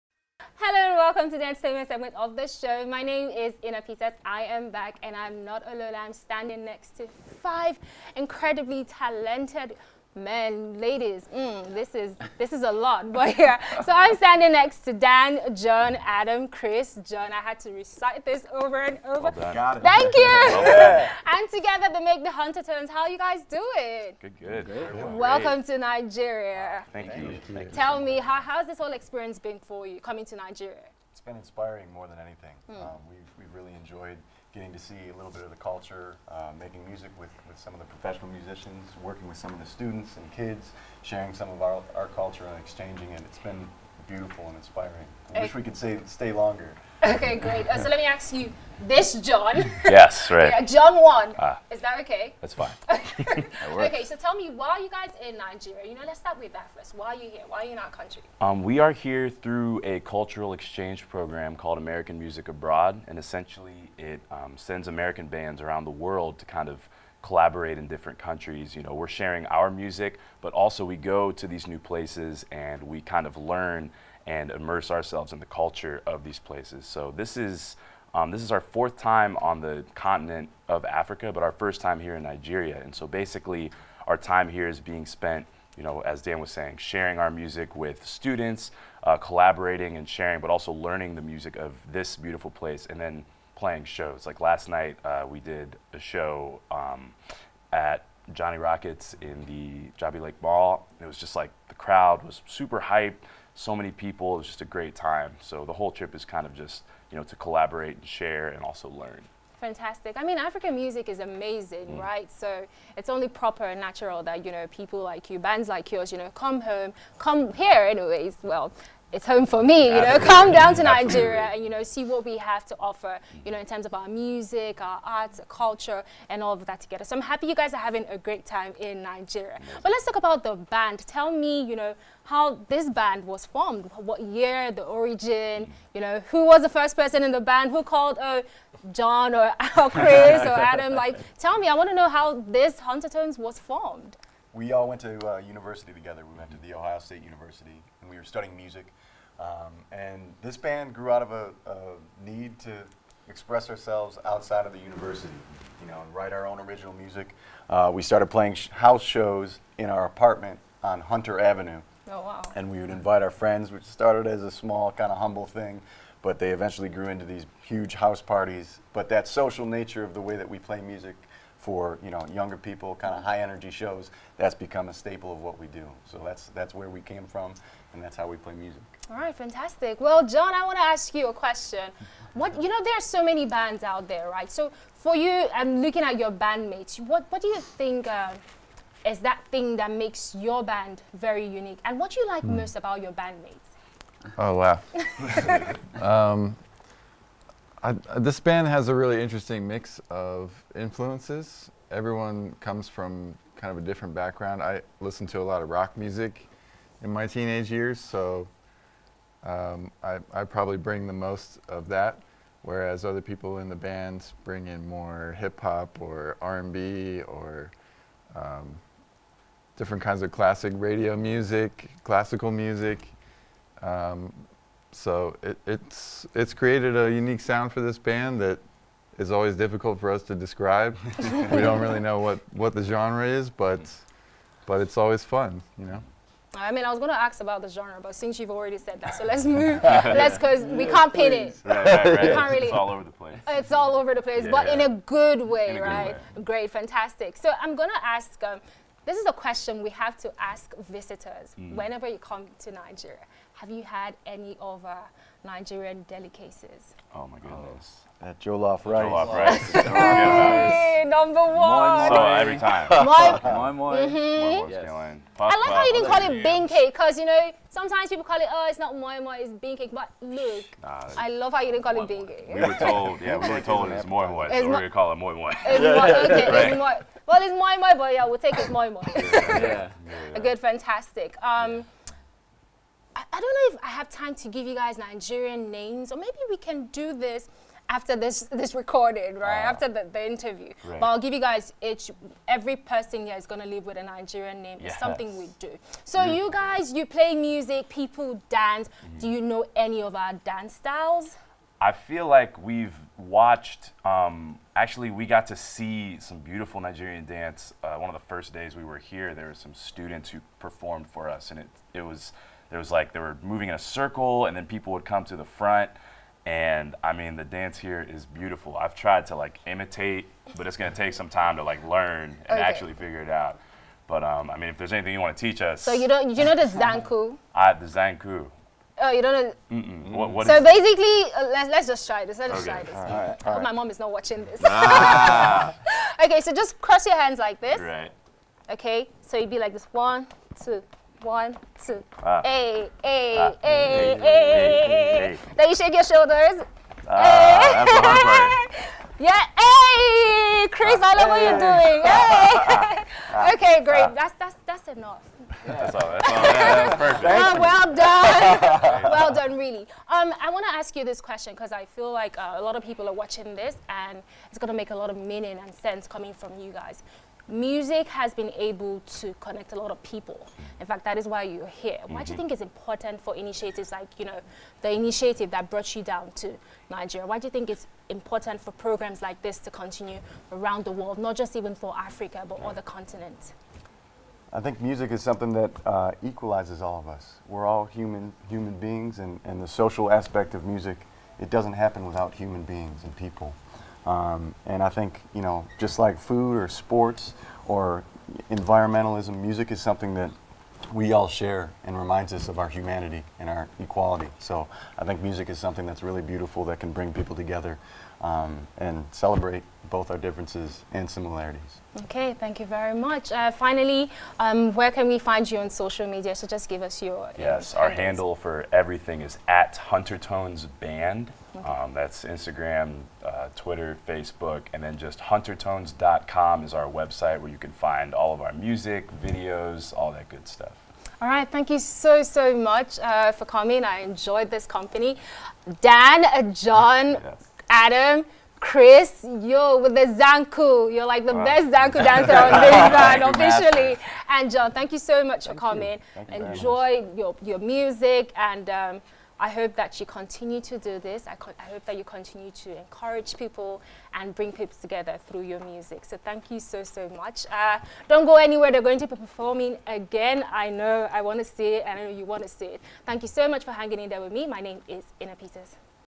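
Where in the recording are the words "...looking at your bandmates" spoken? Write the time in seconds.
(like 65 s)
185 s.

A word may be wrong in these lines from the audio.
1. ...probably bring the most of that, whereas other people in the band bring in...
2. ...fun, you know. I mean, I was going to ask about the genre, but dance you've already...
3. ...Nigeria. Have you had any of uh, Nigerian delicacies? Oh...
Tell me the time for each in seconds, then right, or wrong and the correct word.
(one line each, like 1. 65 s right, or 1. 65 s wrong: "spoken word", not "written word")
1. 210 s right
2. 235 s wrong: "since", not "dance"
3. 252 s right.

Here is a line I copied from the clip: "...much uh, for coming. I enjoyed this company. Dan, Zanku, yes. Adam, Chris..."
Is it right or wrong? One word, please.
wrong.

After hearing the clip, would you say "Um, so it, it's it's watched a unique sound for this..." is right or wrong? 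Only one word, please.
wrong.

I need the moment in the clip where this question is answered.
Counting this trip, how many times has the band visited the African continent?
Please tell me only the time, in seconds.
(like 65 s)
78 s.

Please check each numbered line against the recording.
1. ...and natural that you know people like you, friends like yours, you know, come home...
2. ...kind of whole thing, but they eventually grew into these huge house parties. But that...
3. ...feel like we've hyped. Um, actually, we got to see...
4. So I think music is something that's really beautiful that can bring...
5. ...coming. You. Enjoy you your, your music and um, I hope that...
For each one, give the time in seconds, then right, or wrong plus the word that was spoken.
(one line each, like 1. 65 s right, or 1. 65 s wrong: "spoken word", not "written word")
1. 113 s wrong: "bands", not "friends"
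2. 164 s wrong: "humble", not "whole"
3. 301 s wrong: "watched", not "hyped"
4. 404 s right
5. 445 s right.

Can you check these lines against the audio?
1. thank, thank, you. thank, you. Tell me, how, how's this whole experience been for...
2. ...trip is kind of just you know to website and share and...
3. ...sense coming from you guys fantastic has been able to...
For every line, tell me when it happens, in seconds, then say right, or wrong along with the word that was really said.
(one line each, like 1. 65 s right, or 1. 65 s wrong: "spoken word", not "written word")
1. 26 s right
2. 105 s wrong: "collaborate", not "website"
3. 365 s wrong: "music", not "fantastic".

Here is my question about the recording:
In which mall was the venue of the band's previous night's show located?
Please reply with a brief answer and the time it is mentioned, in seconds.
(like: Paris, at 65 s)
Jabi Lake Mall, at 100 s.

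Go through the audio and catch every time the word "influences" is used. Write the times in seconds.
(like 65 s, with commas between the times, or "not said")
200 s.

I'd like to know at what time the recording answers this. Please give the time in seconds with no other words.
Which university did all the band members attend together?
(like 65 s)
146 s.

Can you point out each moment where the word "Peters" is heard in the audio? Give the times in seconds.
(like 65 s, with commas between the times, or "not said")
3 s, 465 s.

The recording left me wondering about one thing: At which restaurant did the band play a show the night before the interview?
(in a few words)
Johnny Rockets.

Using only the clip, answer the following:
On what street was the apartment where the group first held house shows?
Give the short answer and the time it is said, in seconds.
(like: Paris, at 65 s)
Hunter Avenue, at 161 s.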